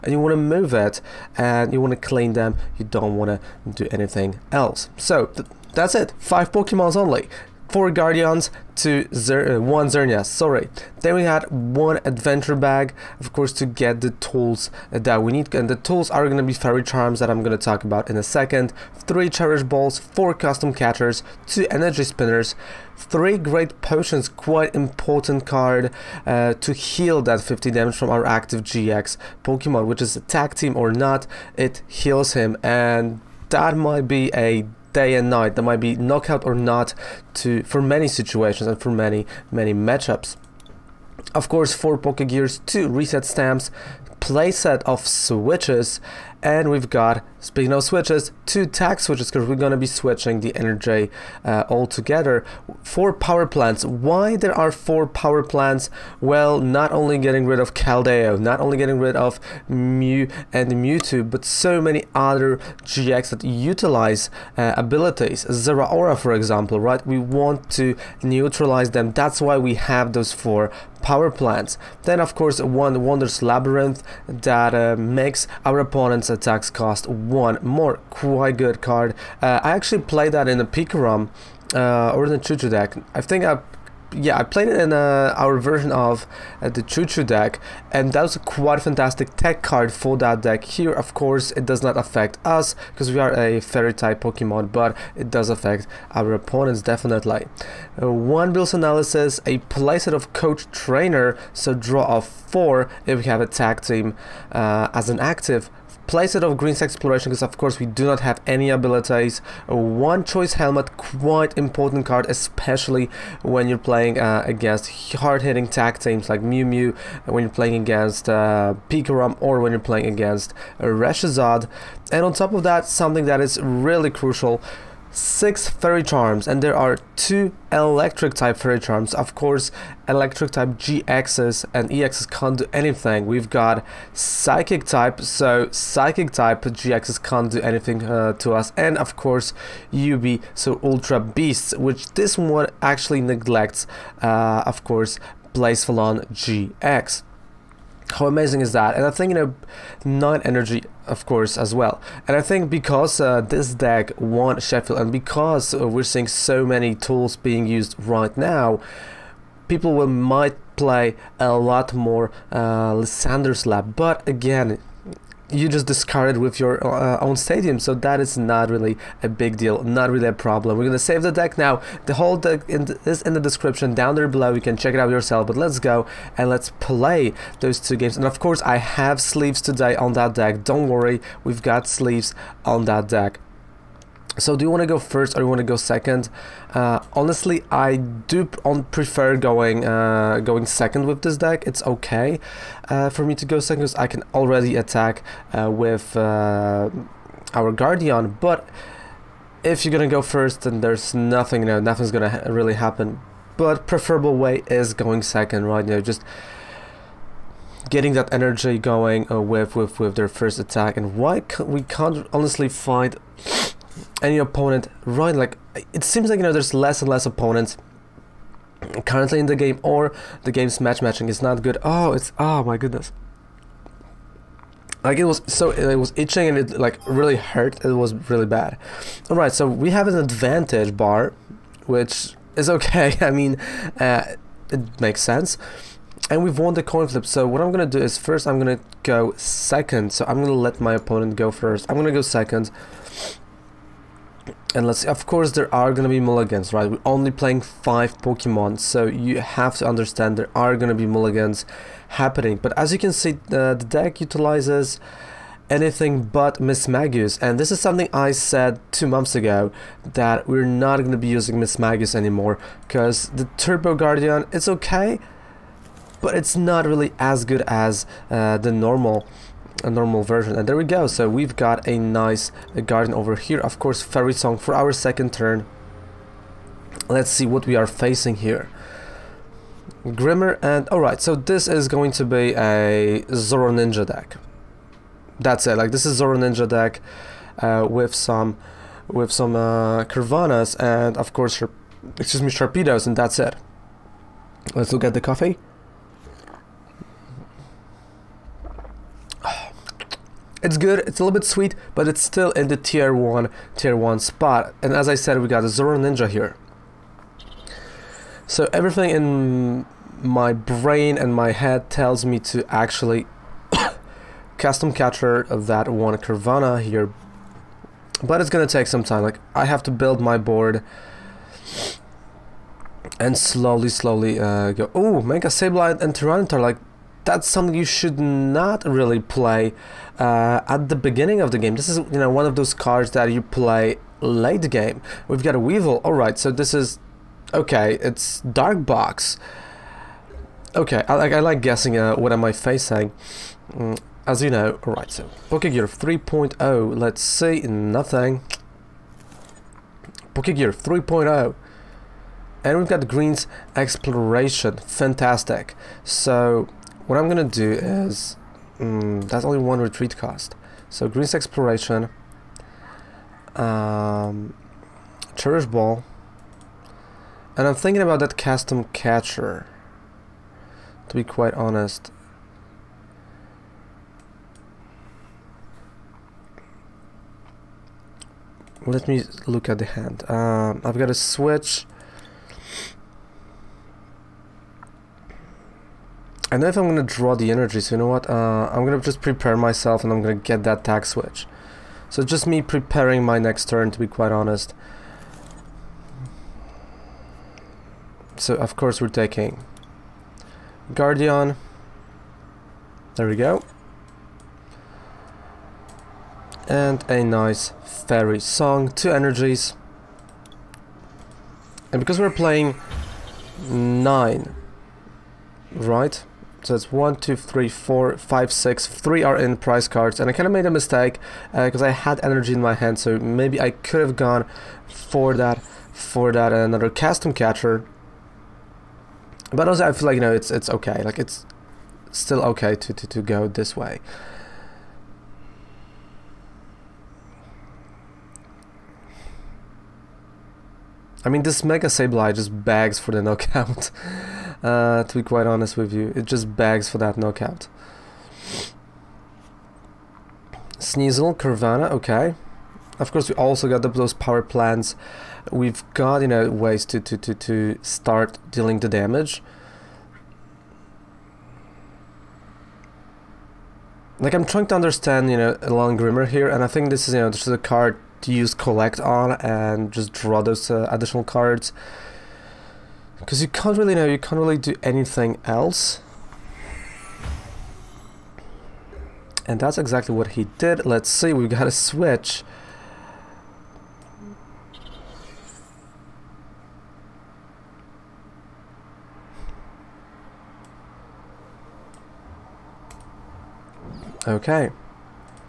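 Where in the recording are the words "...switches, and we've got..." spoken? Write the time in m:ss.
0:45.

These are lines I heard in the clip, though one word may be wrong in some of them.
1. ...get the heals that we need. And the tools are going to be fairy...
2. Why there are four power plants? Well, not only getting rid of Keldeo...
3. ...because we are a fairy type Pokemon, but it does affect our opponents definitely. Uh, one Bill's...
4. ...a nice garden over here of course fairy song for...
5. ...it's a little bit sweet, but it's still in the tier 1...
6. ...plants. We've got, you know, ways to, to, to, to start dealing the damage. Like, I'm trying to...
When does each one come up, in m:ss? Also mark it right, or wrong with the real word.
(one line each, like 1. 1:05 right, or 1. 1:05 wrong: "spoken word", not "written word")
1. 0:13 wrong: "tools", not "heals"
2. 0:53 right
3. 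1:32 right
4. 4:31 right
5. 5:01 right
6. 7:34 right.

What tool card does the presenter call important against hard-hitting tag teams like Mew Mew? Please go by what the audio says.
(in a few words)
Choice Helmet.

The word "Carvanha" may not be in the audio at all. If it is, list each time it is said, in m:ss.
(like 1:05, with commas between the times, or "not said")
4:50, 5:16, 7:31.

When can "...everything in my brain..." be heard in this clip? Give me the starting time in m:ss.
5:08.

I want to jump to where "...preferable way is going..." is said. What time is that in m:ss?
3:23.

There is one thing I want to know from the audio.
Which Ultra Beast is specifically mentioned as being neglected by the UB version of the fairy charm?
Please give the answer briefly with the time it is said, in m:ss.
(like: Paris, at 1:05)
Blacephalon GX, at 2:25.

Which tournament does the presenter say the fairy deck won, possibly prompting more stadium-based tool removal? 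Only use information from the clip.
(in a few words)
Sheffield.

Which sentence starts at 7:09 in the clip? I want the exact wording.
But also, I feel like you know it's it's okay.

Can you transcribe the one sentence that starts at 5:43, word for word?
Mm, as you know, all right.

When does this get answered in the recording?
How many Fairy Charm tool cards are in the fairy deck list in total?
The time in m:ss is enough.
2:05.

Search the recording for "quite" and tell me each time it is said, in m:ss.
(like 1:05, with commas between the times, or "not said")
0:24, 1:18, 1:28, 1:50, 6:11, 6:34, 7:25.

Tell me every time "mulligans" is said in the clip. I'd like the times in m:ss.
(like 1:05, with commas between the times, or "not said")
4:06, 4:11.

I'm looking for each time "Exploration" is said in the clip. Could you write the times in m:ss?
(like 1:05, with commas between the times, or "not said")
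1:46, 5:53, 6:01.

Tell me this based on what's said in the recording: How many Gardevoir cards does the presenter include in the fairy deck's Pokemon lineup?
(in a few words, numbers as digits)
4.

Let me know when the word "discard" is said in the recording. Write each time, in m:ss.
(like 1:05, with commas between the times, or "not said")
2:45.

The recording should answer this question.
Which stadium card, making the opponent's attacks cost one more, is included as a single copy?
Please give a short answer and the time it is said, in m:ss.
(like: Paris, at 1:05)
Wondrous Labyrinth, at 1:13.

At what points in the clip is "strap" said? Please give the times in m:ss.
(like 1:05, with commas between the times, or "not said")
not said.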